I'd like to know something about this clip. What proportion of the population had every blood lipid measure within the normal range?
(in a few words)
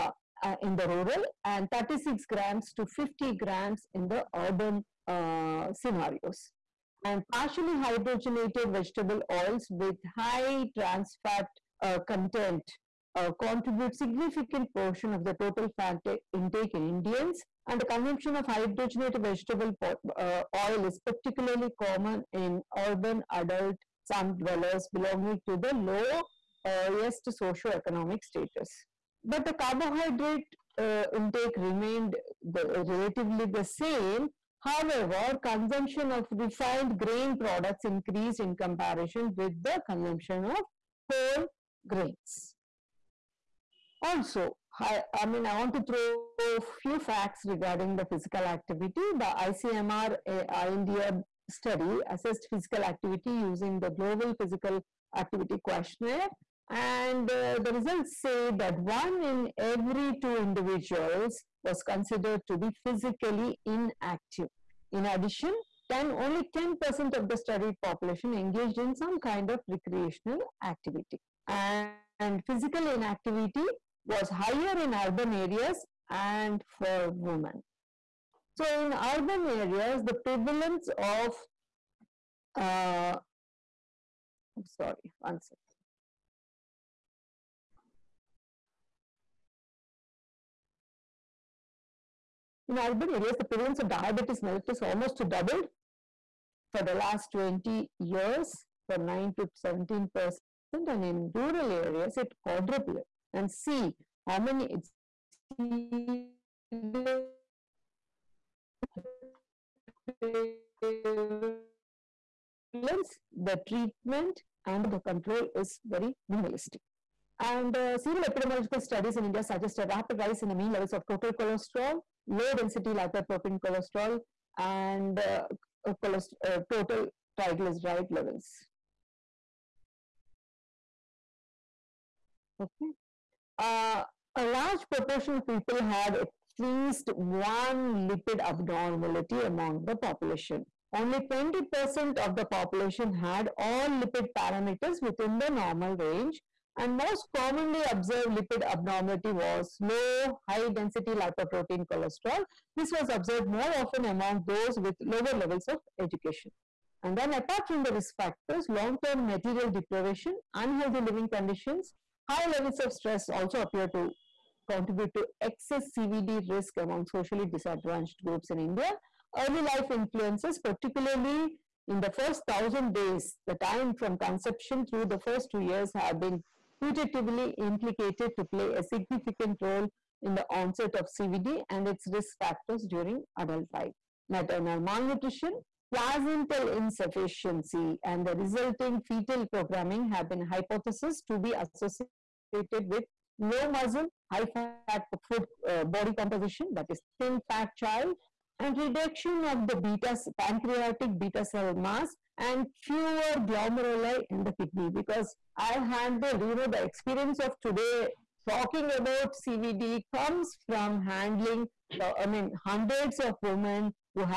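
20%.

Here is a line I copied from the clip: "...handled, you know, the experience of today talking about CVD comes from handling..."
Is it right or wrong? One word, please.
right.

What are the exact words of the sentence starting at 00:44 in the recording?
Also, I, I mean, I want to throw a few facts regarding the physical activity.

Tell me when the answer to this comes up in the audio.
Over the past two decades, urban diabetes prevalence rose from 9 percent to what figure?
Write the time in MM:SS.
01:39.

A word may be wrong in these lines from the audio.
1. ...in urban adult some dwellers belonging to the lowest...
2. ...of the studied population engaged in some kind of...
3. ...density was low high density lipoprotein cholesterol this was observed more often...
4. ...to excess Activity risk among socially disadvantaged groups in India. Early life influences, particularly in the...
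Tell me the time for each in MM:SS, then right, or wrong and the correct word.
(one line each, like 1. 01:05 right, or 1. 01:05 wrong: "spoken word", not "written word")
1. 00:22 right
2. 01:07 right
3. 02:28 wrong: "abnormality", not "density"
4. 02:45 wrong: "CVD", not "Activity".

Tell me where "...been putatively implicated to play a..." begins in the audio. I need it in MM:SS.
02:56.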